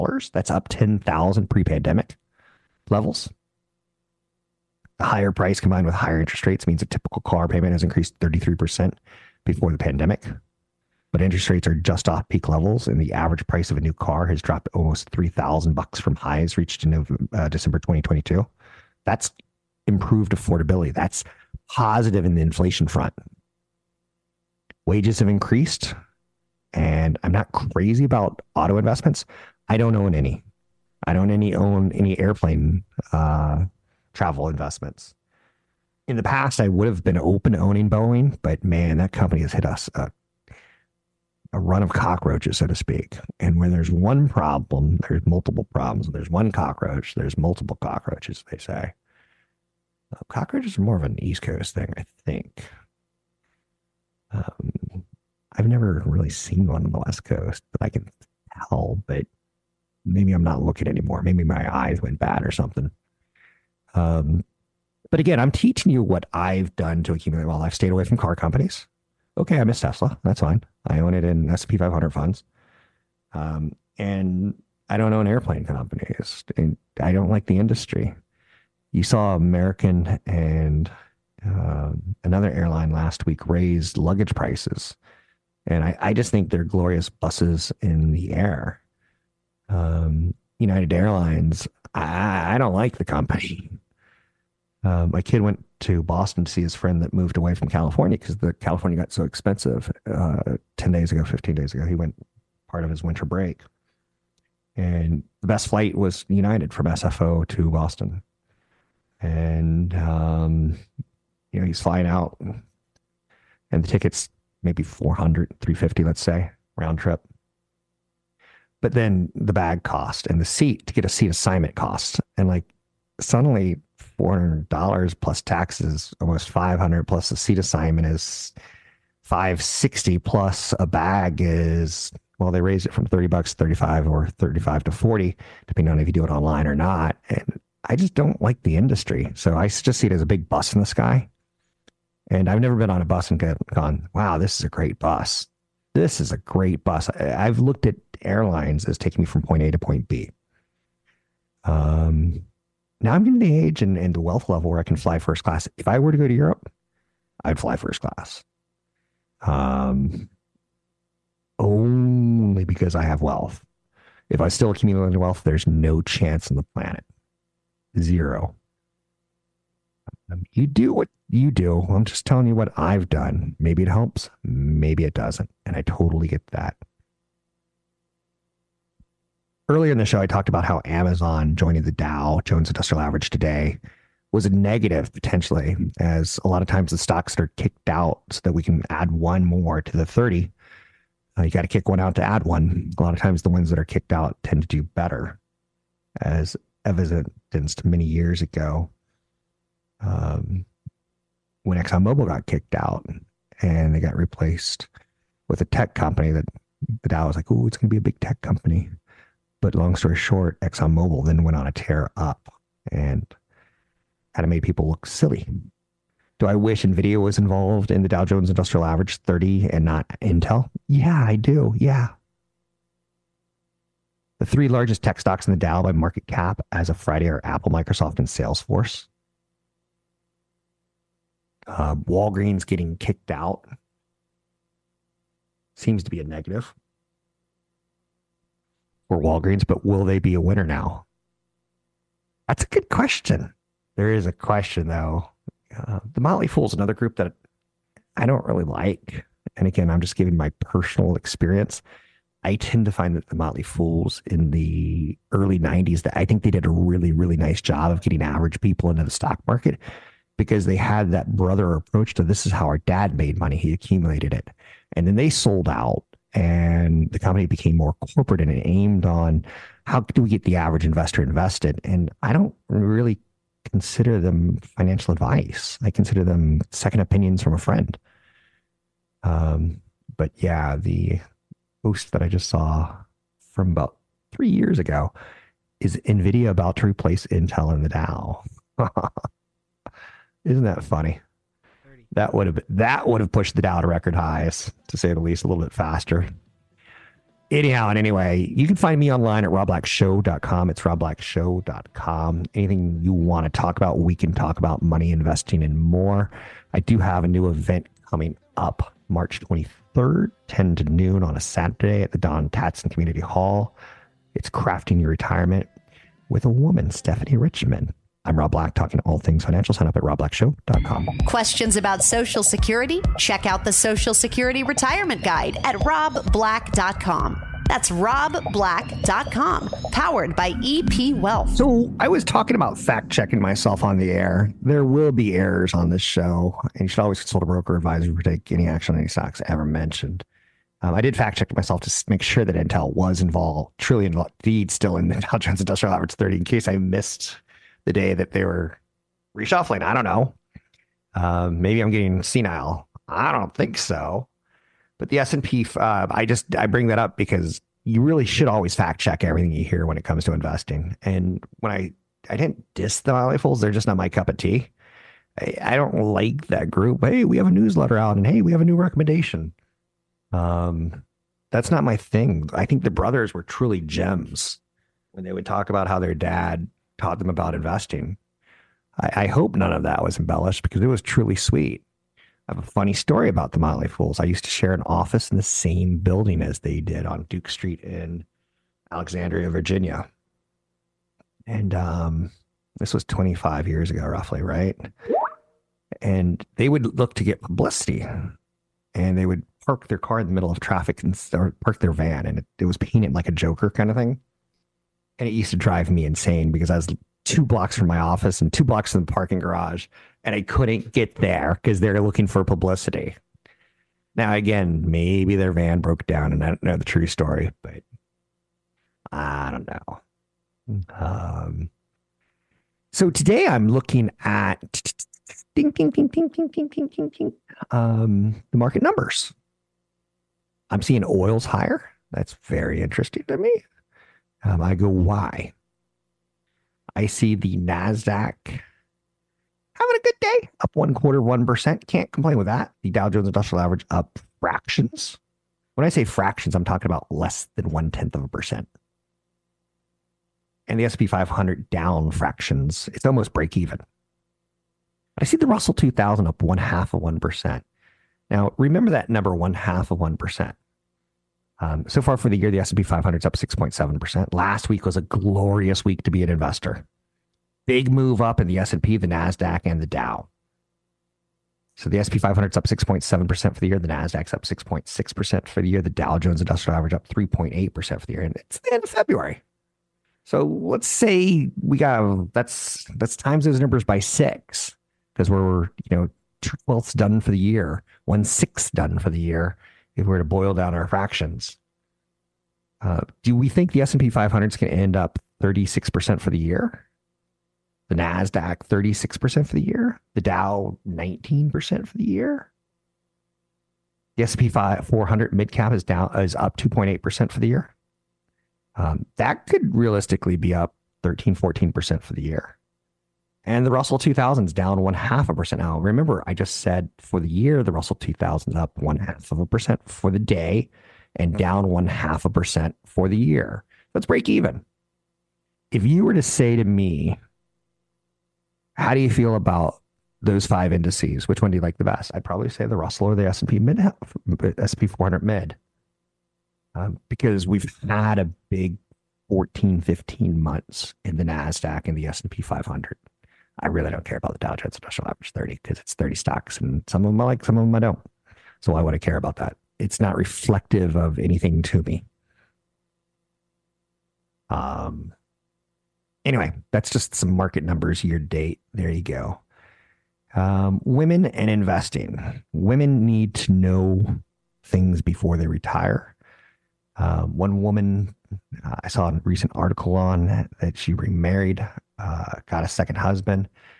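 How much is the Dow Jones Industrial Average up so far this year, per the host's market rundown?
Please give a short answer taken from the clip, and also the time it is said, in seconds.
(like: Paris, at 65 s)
3.8%, at 477 s.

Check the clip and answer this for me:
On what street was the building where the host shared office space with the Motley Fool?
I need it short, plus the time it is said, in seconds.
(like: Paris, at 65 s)
Duke Street, at 387 s.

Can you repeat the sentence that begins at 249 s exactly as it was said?
And again, I'm just giving my personal experience.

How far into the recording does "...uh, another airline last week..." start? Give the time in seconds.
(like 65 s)
81 s.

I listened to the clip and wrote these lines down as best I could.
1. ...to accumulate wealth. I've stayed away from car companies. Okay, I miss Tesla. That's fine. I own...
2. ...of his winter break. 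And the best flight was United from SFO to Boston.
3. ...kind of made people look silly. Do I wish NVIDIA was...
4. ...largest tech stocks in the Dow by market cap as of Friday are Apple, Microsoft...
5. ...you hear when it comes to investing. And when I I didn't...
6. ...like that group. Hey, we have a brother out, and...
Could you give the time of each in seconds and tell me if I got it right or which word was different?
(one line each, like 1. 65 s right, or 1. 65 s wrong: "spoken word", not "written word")
1. 67 s right
2. 102 s right
3. 214 s right
4. 224 s right
5. 359 s right
6. 366 s wrong: "newsletter", not "brother".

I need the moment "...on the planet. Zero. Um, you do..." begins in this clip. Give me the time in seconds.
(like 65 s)
166 s.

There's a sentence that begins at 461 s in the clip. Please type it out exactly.
Um, so far for the year, the S&P 500 is up 6.7%.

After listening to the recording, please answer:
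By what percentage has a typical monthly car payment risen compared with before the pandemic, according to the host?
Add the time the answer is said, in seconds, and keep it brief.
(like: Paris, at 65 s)
33%, at 8 s.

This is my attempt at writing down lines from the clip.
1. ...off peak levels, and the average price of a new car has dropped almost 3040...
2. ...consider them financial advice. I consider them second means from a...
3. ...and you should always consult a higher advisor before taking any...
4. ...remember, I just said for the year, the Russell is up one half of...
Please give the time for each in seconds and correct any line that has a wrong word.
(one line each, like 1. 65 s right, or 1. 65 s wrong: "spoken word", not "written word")
1. 12 s wrong: "3000", not "3040"
2. 273 s wrong: "opinions", not "means"
3. 336 s wrong: "broker", not "higher"
4. 515 s right.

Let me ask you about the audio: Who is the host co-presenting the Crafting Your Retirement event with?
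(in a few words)
Stephanie Richmond.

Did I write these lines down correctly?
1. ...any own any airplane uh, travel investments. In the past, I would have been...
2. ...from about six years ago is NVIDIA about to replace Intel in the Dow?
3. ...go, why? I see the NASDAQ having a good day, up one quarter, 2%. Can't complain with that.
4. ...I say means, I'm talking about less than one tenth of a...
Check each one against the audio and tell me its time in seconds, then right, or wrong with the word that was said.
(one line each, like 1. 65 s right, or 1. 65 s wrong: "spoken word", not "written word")
1. 31 s right
2. 283 s wrong: "three", not "six"
3. 434 s wrong: "1", not "2"
4. 445 s wrong: "fractions", not "means".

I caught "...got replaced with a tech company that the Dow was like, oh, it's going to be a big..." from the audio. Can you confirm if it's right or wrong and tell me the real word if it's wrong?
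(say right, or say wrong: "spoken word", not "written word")
right.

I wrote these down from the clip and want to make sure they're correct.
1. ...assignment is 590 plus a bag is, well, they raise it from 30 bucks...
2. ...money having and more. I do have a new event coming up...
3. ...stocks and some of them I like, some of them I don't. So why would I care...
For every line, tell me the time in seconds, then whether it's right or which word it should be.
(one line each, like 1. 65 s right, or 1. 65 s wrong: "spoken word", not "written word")
1. 127 s wrong: "560", not "590"
2. 304 s wrong: "investing", not "having"
3. 546 s right.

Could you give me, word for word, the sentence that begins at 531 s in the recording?
Which one do you like the best?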